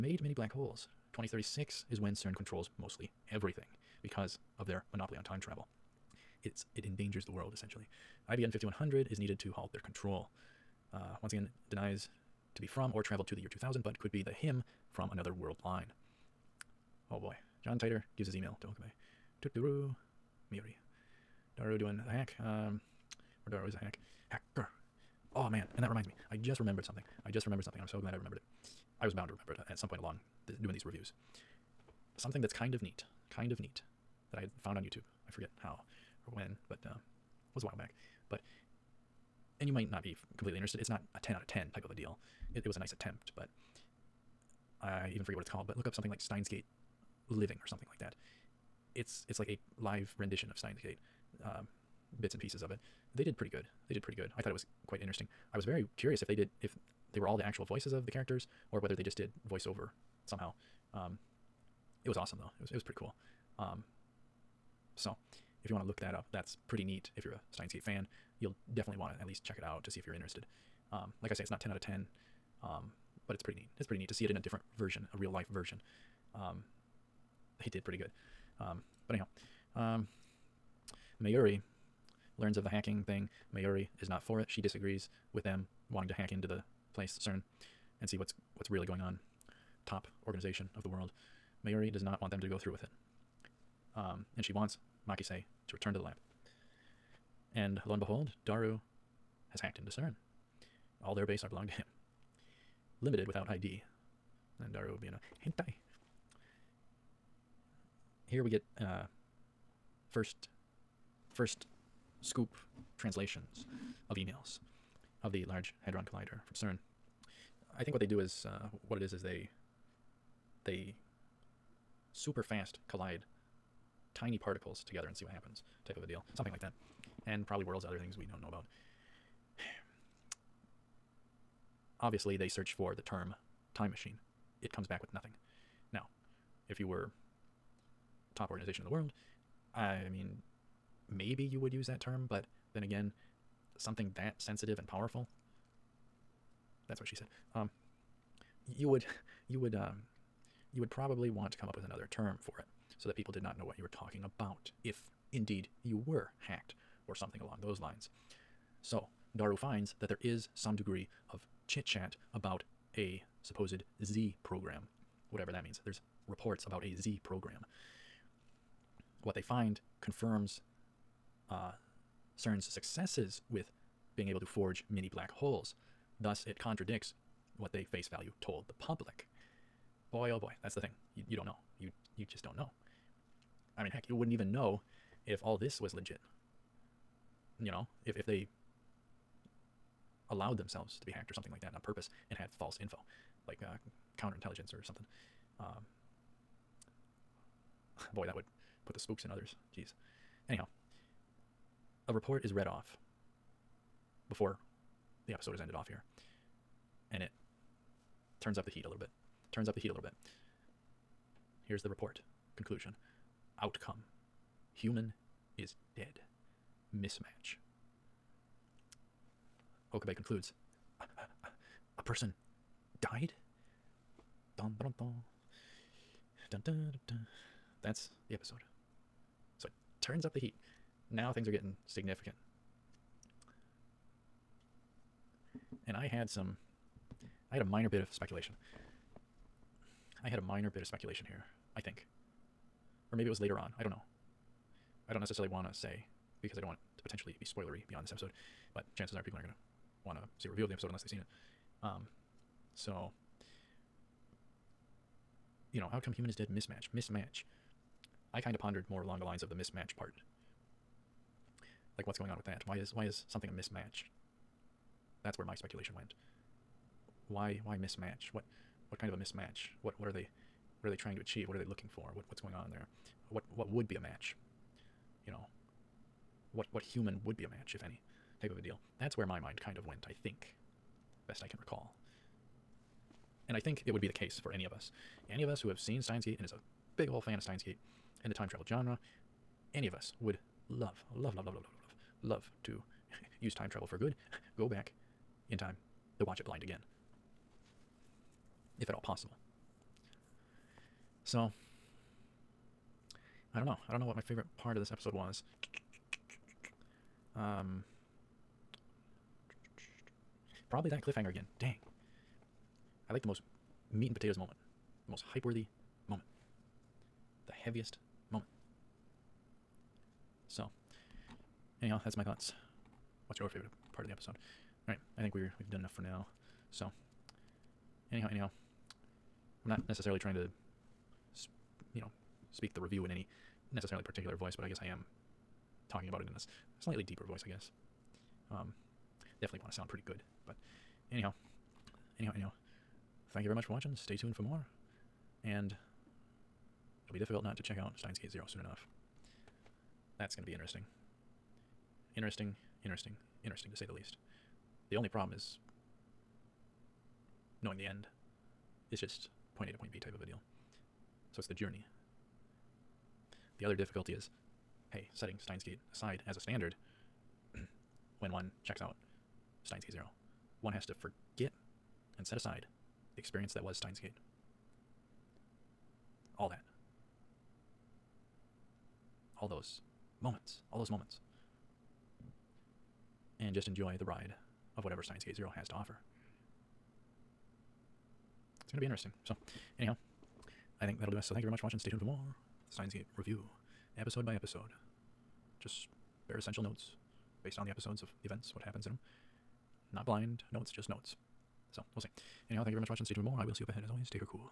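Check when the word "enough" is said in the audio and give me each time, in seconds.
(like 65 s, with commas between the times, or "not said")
325 s, 348 s.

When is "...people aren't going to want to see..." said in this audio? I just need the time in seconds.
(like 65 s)
249 s.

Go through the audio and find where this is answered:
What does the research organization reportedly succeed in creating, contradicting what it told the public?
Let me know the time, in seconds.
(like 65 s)
174 s.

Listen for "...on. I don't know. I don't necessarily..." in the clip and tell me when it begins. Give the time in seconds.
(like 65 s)
243 s.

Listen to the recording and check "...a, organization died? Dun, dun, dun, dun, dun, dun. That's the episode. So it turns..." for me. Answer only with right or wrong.
wrong.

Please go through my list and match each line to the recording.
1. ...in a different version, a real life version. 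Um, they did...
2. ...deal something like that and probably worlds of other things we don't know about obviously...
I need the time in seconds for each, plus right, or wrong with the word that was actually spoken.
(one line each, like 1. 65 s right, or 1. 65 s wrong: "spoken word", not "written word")
1. 74 s right
2. 126 s right.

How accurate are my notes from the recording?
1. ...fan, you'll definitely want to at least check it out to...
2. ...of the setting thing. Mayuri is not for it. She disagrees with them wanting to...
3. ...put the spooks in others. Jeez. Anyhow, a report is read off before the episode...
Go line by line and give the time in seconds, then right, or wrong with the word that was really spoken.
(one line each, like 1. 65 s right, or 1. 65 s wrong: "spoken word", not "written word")
1. 67 s right
2. 82 s wrong: "hacking", not "setting"
3. 198 s right.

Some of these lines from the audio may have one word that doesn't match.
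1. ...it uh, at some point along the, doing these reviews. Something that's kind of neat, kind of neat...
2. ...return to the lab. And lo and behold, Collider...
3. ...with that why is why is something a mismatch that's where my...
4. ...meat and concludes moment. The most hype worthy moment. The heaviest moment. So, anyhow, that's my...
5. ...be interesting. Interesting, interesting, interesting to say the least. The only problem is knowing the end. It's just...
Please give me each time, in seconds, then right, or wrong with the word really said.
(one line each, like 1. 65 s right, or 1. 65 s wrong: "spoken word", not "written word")
1. 29 s right
2. 95 s wrong: "Daru", not "Collider"
3. 262 s right
4. 313 s wrong: "potatoes", not "concludes"
5. 350 s right.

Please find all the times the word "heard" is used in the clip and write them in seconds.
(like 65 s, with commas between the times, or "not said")
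not said.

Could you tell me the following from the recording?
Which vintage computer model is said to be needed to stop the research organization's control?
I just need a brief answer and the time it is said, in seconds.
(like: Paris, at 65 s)
IBM 5100, at 8 s.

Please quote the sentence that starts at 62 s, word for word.
It was it was pretty cool.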